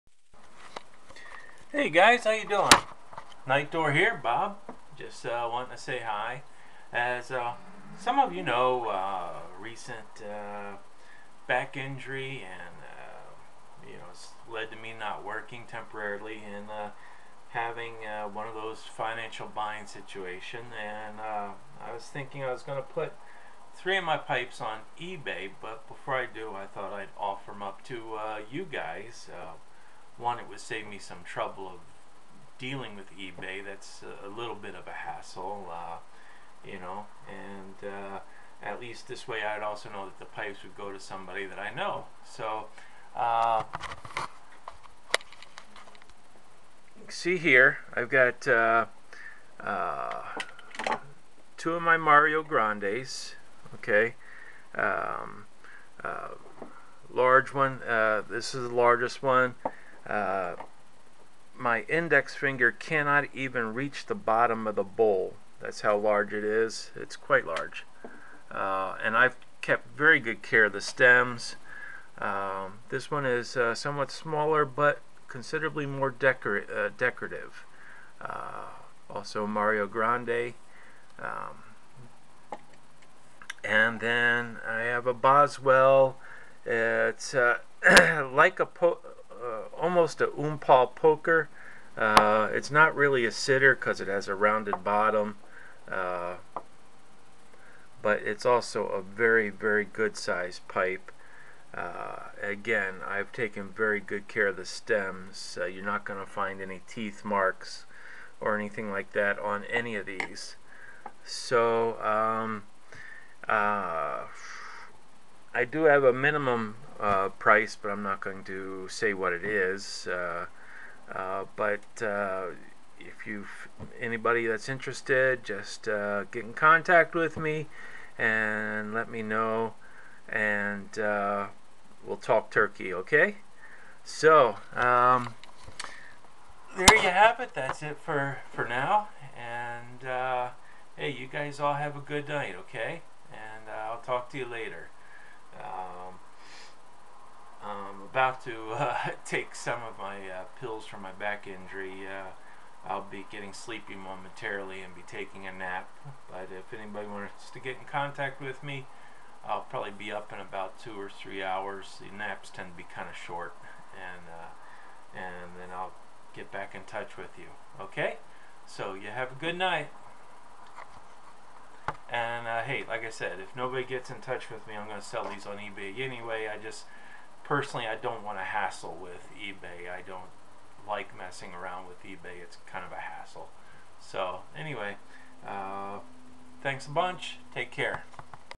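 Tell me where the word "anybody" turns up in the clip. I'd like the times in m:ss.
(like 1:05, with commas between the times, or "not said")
2:03, 2:36.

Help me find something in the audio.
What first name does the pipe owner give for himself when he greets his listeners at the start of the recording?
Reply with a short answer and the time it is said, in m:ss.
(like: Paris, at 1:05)
Bob, at 0:04.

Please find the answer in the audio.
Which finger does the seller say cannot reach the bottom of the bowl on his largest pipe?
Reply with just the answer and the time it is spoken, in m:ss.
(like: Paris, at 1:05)
Index finger, at 1:01.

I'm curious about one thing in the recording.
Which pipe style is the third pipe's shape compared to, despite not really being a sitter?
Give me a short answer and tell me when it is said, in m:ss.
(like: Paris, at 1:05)
Poker, at 1:30.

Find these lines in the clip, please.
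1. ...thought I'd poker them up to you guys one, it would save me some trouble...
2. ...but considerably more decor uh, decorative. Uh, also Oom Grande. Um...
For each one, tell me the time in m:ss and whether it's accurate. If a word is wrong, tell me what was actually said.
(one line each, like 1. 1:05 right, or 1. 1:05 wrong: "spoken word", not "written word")
1. 0:26 wrong: "offer", not "poker"
2. 1:14 wrong: "Mario", not "Oom".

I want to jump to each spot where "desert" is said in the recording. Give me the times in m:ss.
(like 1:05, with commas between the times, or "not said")
not said.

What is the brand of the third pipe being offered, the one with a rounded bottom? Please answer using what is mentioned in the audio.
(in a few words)
Boswell.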